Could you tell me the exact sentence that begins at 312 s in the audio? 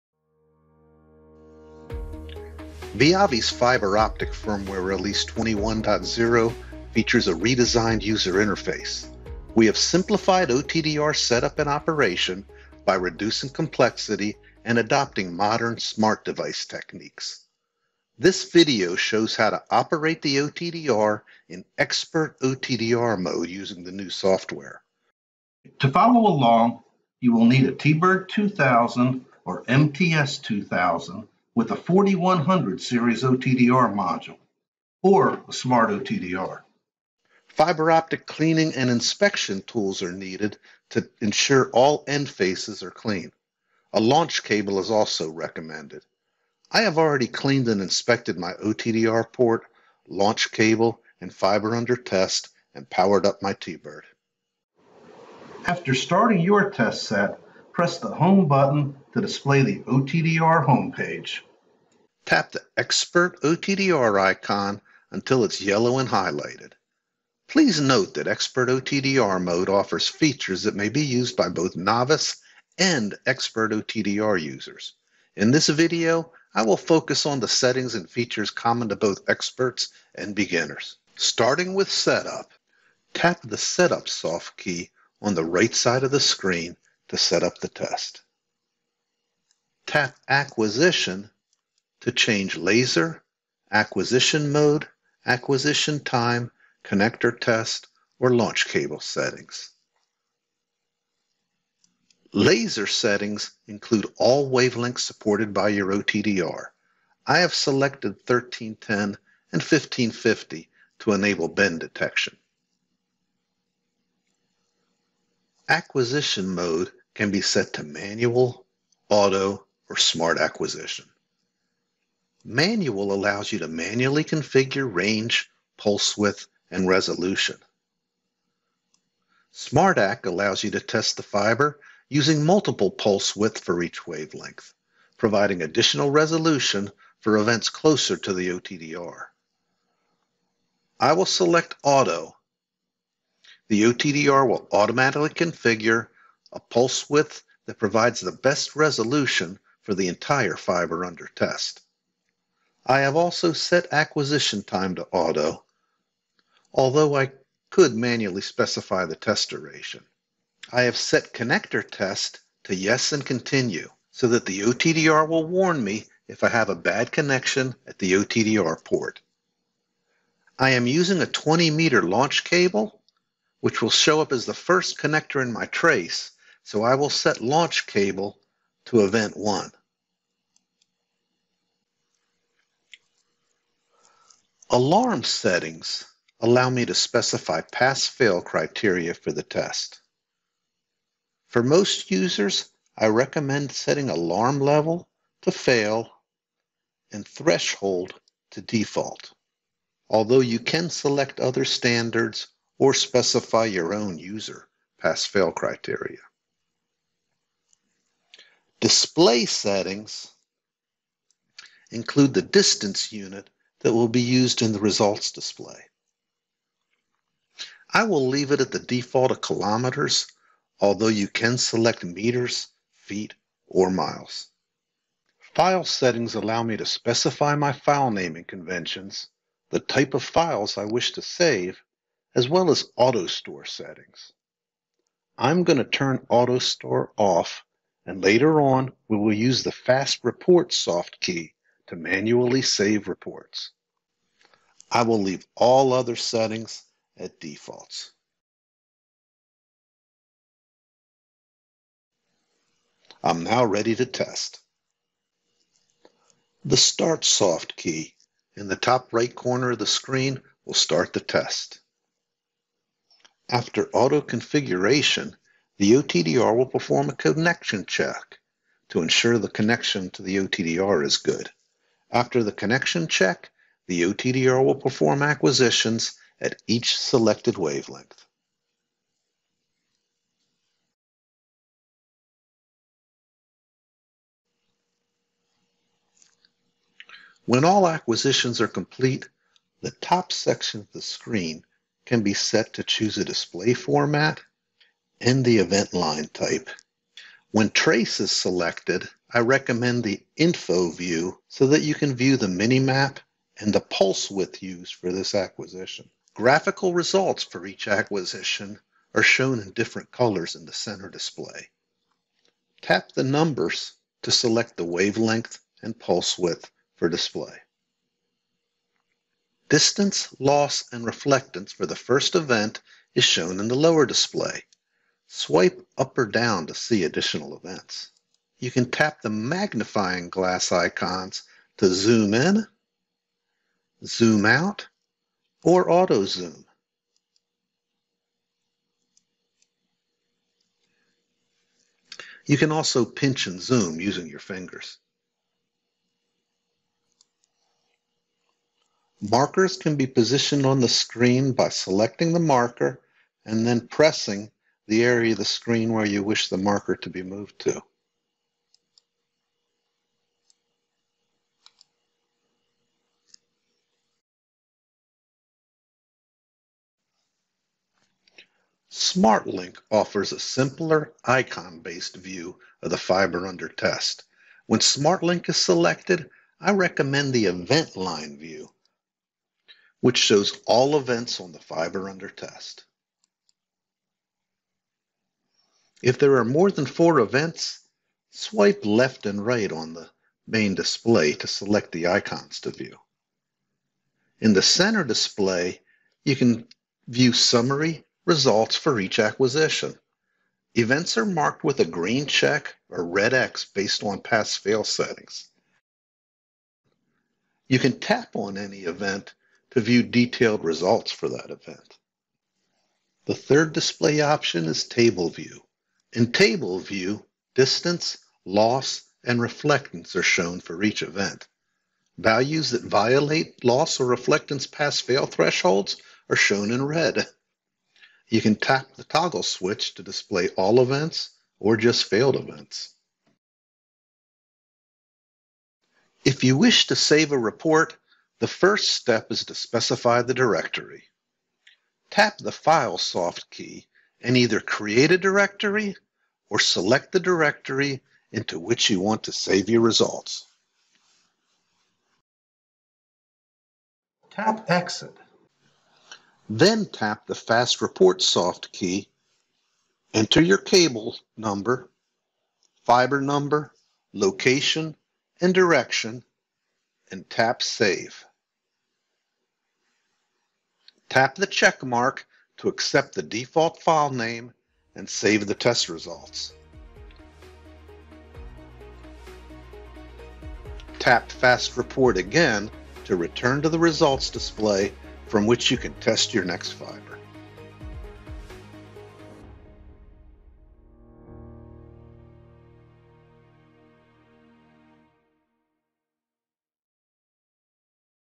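Tap the numbers to select the wavelength and pulse width for display.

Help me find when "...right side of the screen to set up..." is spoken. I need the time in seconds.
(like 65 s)
85 s.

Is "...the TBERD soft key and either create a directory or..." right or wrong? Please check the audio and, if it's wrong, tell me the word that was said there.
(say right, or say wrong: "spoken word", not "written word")
wrong: "File", not "TBERD".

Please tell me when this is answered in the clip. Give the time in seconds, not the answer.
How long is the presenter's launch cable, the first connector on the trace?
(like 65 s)
171 s.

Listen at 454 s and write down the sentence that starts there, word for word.
Tap Exit then tap the Fast Report soft key, enter your cable number, fiber number, location, and direction, and tap Save.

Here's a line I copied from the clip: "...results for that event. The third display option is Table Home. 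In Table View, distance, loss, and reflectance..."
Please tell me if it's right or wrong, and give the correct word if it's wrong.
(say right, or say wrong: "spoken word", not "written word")
wrong: "View", not "Home".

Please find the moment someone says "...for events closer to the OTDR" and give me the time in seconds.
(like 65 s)
137 s.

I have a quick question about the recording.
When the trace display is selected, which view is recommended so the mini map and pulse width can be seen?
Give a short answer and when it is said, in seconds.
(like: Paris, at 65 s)
info view, at 300 s.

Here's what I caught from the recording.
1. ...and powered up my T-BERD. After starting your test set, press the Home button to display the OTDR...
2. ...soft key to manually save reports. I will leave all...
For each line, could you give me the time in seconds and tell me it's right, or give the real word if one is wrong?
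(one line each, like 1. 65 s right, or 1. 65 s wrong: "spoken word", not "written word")
1. 52 s right
2. 240 s right.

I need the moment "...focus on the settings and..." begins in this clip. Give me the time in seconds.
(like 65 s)
76 s.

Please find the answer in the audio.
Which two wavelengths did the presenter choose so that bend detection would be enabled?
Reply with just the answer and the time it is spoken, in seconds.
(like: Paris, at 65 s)
1310 and 1550, at 108 s.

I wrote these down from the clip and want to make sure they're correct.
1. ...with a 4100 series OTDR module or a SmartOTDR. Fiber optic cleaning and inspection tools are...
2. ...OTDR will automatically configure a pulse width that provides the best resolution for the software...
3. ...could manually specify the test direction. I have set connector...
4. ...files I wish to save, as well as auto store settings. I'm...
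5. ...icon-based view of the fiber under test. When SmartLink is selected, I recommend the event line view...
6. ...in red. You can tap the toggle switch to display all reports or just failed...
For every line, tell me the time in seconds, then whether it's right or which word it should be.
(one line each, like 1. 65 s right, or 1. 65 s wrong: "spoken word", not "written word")
1. 31 s right
2. 143 s wrong: "entire", not "software"
3. 157 s wrong: "duration", not "direction"
4. 230 s right
5. 371 s right
6. 426 s wrong: "events", not "reports".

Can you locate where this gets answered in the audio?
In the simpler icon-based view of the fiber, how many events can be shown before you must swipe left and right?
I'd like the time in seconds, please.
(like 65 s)
386 s.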